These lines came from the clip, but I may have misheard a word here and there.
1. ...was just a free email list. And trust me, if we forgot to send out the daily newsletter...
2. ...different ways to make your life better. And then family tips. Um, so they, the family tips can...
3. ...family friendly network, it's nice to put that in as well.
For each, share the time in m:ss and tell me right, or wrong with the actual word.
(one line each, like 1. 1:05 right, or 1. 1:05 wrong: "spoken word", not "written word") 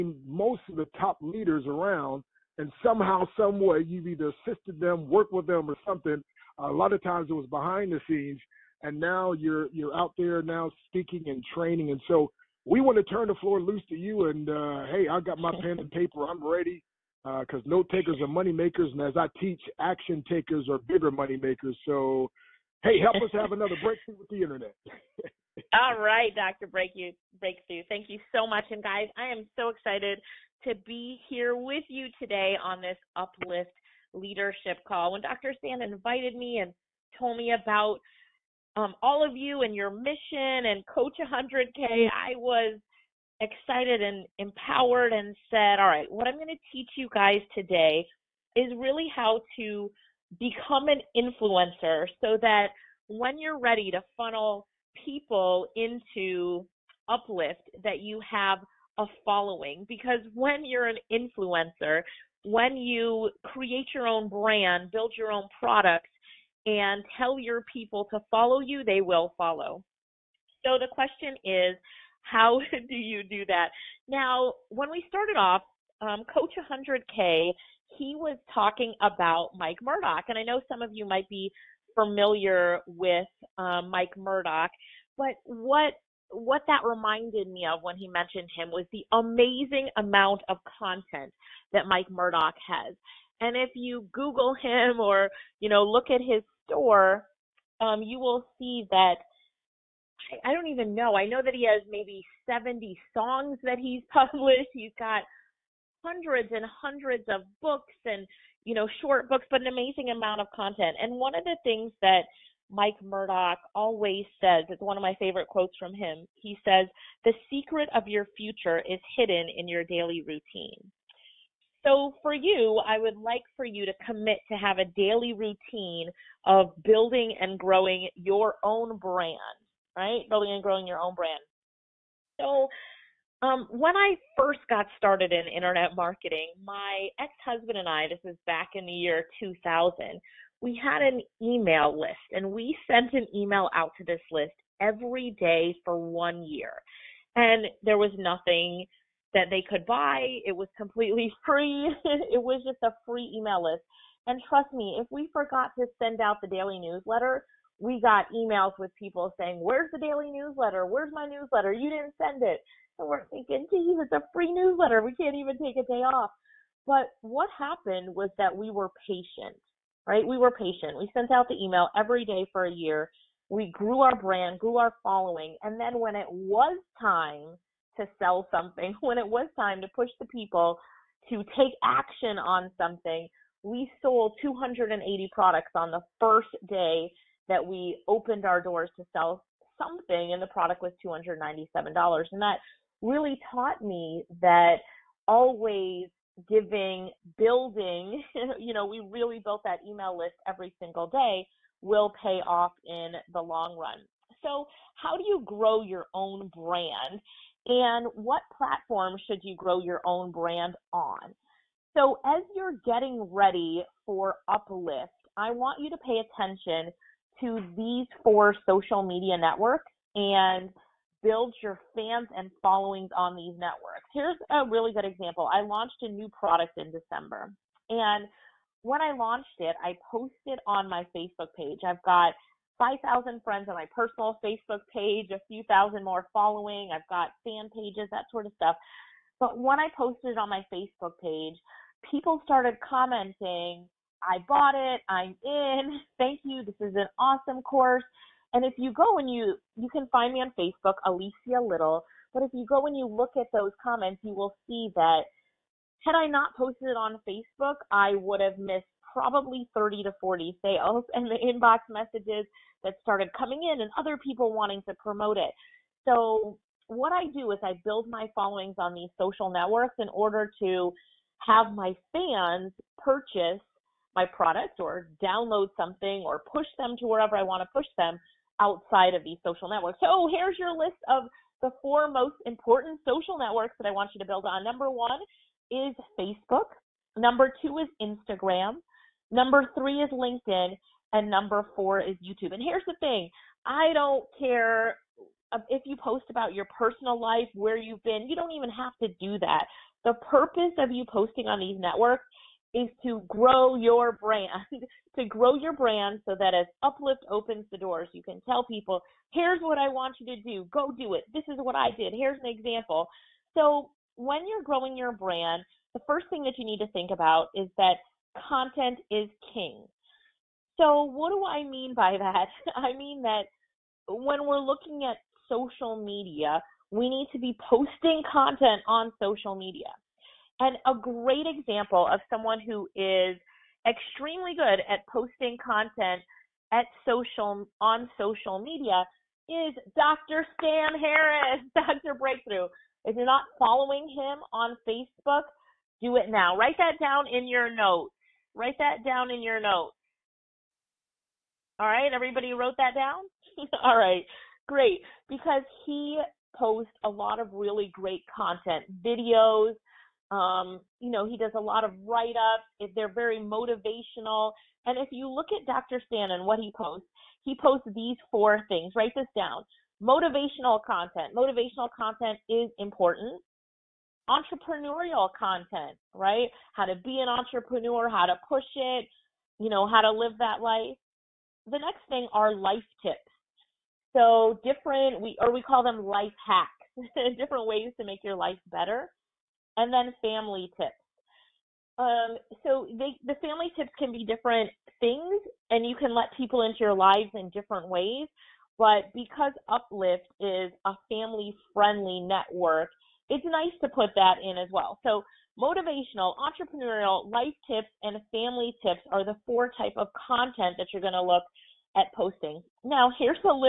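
1. 2:32 right
2. 6:27 right
3. 6:41 right.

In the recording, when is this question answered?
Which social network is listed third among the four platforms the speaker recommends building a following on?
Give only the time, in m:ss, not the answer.
4:50.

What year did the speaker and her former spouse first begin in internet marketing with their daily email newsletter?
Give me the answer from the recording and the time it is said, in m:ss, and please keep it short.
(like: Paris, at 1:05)
2000, at 2:19.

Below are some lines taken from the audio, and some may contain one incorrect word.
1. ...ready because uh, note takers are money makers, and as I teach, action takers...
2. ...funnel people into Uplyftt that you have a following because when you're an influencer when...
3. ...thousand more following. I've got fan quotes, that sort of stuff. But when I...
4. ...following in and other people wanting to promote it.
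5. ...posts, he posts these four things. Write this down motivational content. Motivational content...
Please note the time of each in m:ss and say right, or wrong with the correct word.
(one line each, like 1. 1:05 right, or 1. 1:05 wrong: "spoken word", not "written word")
1. 0:16 right
2. 0:54 right
3. 3:55 wrong: "pages", not "quotes"
4. 4:23 wrong: "coming", not "following"
5. 6:06 right.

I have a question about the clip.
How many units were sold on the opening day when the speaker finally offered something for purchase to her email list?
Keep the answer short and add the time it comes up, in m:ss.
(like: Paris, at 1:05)
280, at 3:04.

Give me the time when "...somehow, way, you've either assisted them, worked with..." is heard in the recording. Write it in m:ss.
0:02.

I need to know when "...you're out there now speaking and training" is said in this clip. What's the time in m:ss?
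0:09.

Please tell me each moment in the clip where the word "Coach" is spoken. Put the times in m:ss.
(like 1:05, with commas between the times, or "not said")
0:40, 1:16.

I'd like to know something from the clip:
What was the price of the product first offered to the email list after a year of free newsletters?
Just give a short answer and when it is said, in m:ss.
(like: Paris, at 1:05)
$297, at 3:11.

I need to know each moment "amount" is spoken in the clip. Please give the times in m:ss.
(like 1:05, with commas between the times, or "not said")
1:29, 1:50.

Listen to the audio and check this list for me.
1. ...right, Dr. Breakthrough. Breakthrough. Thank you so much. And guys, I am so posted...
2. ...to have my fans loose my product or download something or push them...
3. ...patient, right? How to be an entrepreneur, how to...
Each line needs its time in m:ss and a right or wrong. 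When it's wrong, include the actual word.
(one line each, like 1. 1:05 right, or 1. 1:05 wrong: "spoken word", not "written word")
1. 0:25 wrong: "excited", not "posted"
2. 4:30 wrong: "purchase", not "loose"
3. 6:15 wrong: "content", not "patient".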